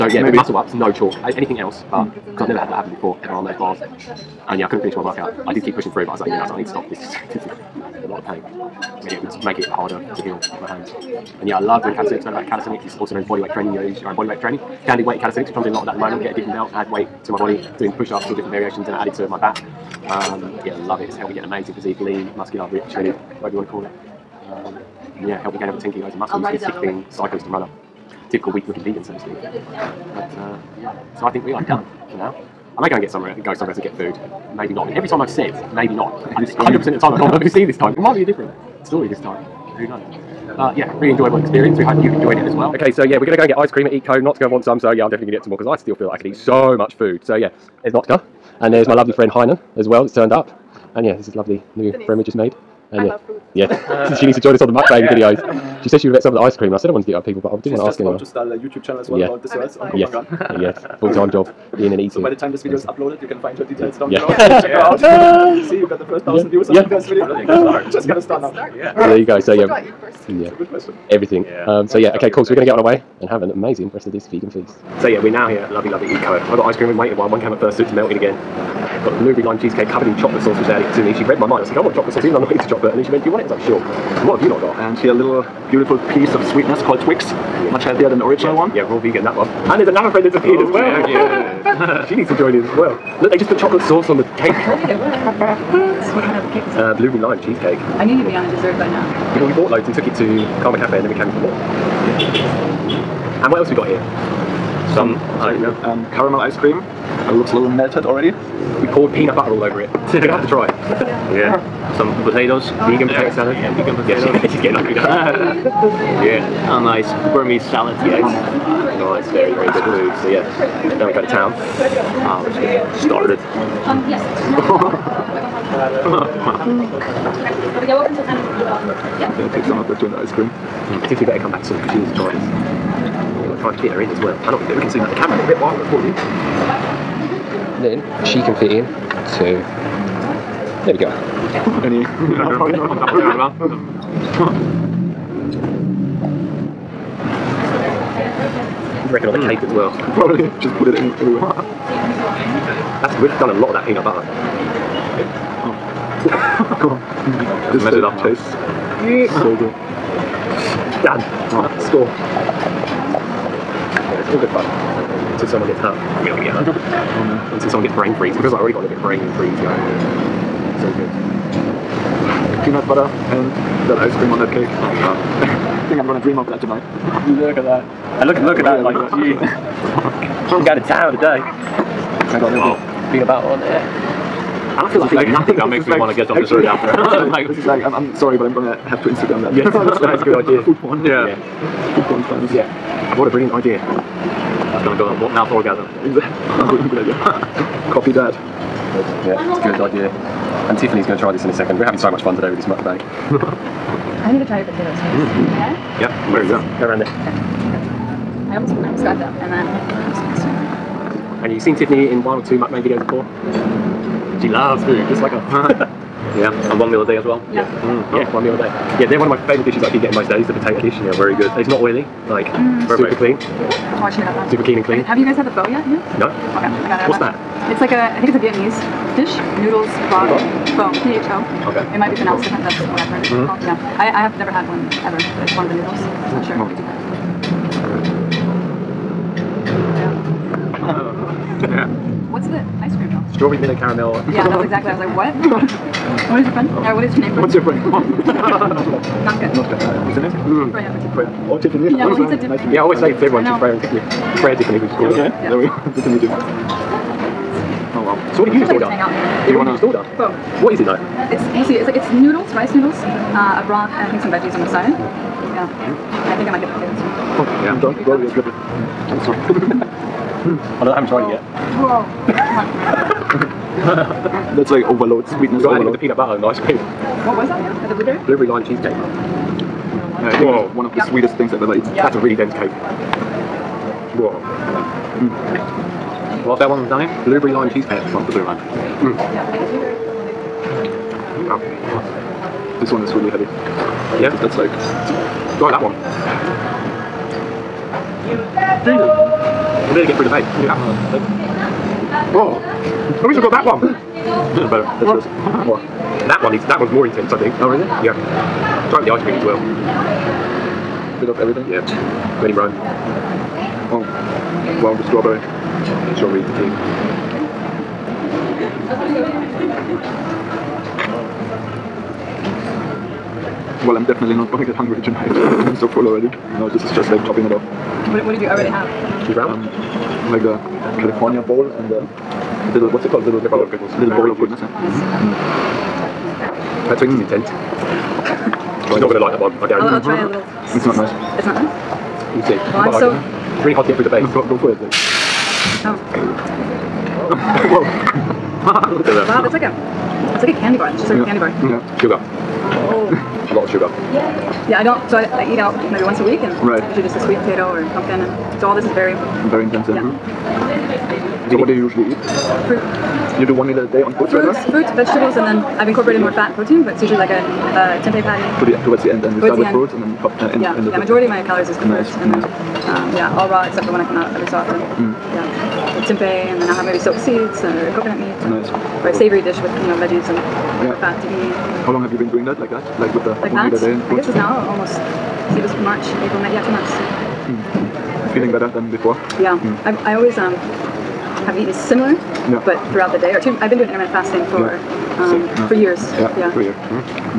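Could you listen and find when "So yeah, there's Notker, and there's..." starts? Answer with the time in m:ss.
0:47.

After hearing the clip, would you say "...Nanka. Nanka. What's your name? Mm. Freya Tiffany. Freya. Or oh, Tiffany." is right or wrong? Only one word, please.
right.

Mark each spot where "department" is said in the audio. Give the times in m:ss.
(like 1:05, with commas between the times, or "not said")
not said.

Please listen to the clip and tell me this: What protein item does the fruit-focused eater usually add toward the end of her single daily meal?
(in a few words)
tempeh patty.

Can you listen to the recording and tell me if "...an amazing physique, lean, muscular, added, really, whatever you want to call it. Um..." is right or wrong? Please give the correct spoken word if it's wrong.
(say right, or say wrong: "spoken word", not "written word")
wrong: "ripped", not "added".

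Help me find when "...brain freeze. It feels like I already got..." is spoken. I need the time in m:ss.
2:47.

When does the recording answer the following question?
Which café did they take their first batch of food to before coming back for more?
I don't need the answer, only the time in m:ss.
1:40.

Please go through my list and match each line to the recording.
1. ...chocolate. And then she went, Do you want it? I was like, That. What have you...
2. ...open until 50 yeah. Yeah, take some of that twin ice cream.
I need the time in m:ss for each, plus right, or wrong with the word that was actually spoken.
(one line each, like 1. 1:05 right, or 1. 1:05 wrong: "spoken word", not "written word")
1. 1:22 wrong: "Sure", not "That"
2. 2:08 wrong: "10", not "50".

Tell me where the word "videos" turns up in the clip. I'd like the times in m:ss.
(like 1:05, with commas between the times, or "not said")
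0:55, 1:02, 1:07, 3:32.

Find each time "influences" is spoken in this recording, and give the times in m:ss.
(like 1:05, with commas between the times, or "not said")
not said.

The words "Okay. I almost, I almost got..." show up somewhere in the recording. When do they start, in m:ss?
3:27.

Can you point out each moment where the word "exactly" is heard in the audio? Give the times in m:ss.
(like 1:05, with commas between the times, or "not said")
3:16, 4:04.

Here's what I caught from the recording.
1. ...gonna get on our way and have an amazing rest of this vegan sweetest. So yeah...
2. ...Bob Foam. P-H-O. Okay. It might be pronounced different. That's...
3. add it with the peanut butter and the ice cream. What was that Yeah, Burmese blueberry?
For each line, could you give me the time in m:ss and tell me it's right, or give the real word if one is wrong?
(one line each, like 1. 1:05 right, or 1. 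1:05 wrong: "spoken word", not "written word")
1. 1:12 wrong: "feast", not "sweetest"
2. 3:50 right
3. 4:35 wrong: "The", not "Burmese".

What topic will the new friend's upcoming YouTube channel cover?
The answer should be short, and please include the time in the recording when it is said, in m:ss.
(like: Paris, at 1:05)
desserts on Koh Phangan, at 0:59.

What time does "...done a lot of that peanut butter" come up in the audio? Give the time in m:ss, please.
2:33.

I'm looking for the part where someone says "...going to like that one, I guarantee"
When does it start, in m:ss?
5:39.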